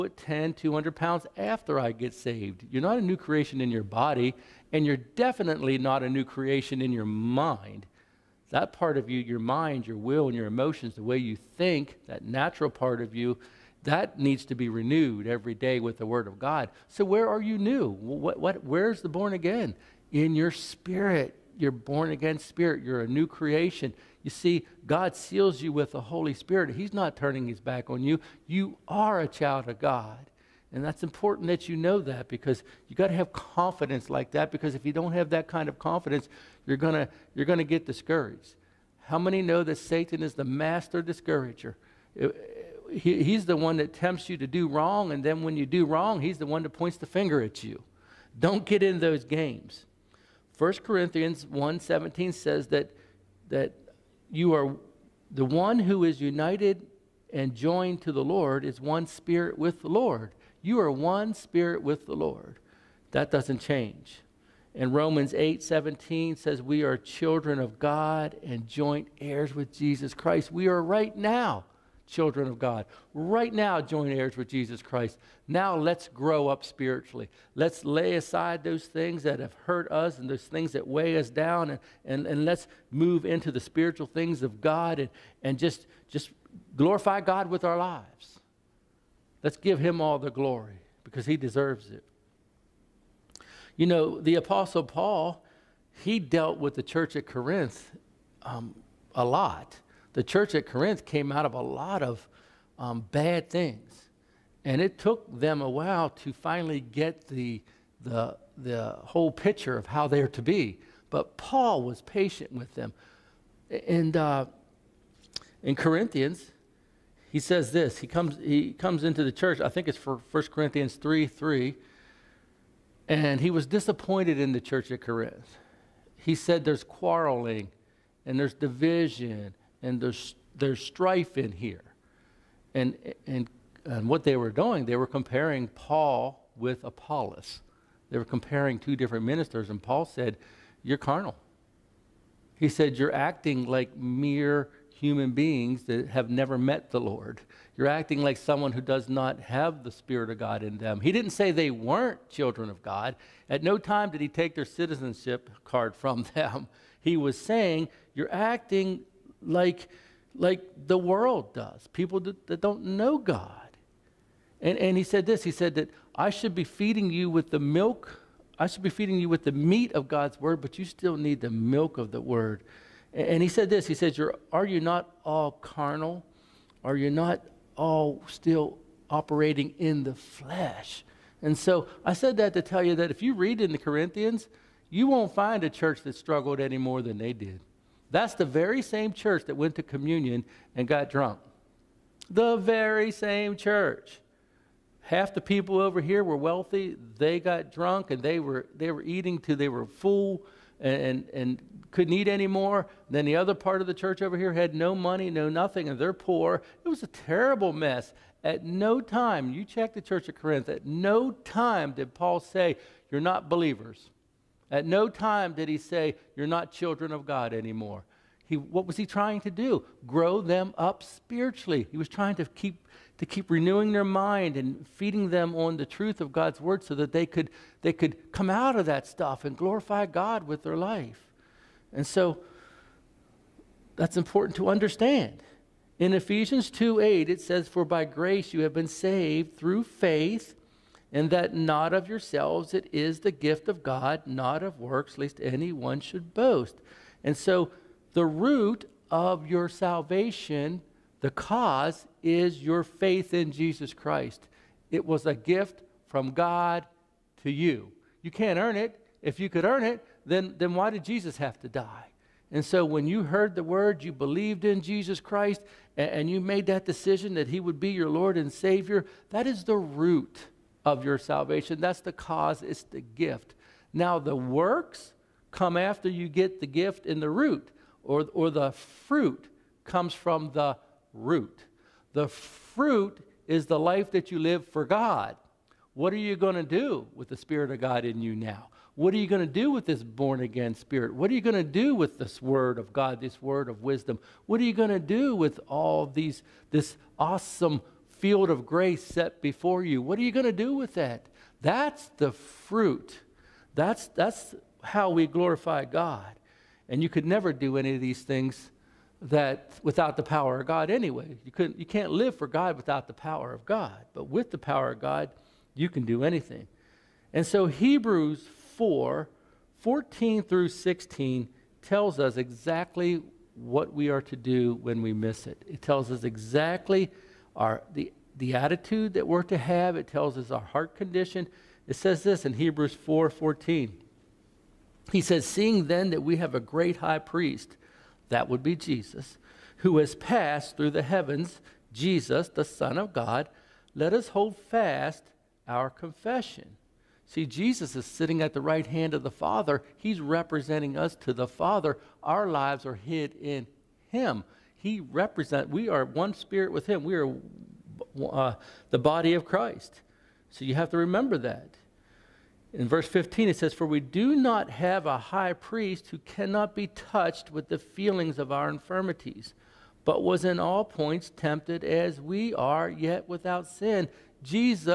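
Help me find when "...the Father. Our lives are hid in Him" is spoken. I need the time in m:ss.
5:51.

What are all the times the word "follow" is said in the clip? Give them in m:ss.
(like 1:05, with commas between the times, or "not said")
not said.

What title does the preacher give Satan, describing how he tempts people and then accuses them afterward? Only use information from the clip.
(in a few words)
Master discourager.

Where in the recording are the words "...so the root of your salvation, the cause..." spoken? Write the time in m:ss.
4:07.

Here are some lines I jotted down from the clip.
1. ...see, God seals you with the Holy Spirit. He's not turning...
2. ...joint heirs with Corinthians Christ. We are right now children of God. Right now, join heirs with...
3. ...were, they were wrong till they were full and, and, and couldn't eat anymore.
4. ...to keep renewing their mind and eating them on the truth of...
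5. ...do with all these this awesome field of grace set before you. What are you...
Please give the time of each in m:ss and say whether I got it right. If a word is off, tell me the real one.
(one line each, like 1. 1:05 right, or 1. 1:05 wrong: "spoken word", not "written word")
1. 0:24 right
2. 1:08 wrong: "Jesus", not "Corinthians"
3. 3:18 wrong: "eating", not "wrong"
4. 3:43 wrong: "feeding", not "eating"
5. 4:54 right.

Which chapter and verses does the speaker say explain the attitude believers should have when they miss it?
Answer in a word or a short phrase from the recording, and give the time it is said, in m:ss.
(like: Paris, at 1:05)
Hebrews 4:14-16, at 5:17.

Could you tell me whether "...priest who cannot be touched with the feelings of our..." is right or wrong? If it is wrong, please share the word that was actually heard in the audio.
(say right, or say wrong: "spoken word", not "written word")
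right.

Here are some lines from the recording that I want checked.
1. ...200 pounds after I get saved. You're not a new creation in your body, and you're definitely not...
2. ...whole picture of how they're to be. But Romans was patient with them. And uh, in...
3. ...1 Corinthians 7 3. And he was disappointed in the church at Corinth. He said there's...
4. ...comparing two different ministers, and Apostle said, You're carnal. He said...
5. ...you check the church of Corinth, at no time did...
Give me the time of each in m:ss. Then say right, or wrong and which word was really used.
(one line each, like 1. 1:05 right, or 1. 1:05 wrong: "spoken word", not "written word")
1. 0:00 right
2. 1:48 wrong: "Paul", not "Romans"
3. 2:00 wrong: "3", not "7"
4. 2:18 wrong: "Paul", not "Apostle"
5. 3:29 right.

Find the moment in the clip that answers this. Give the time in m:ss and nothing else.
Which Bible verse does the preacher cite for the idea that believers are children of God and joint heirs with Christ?
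1:04.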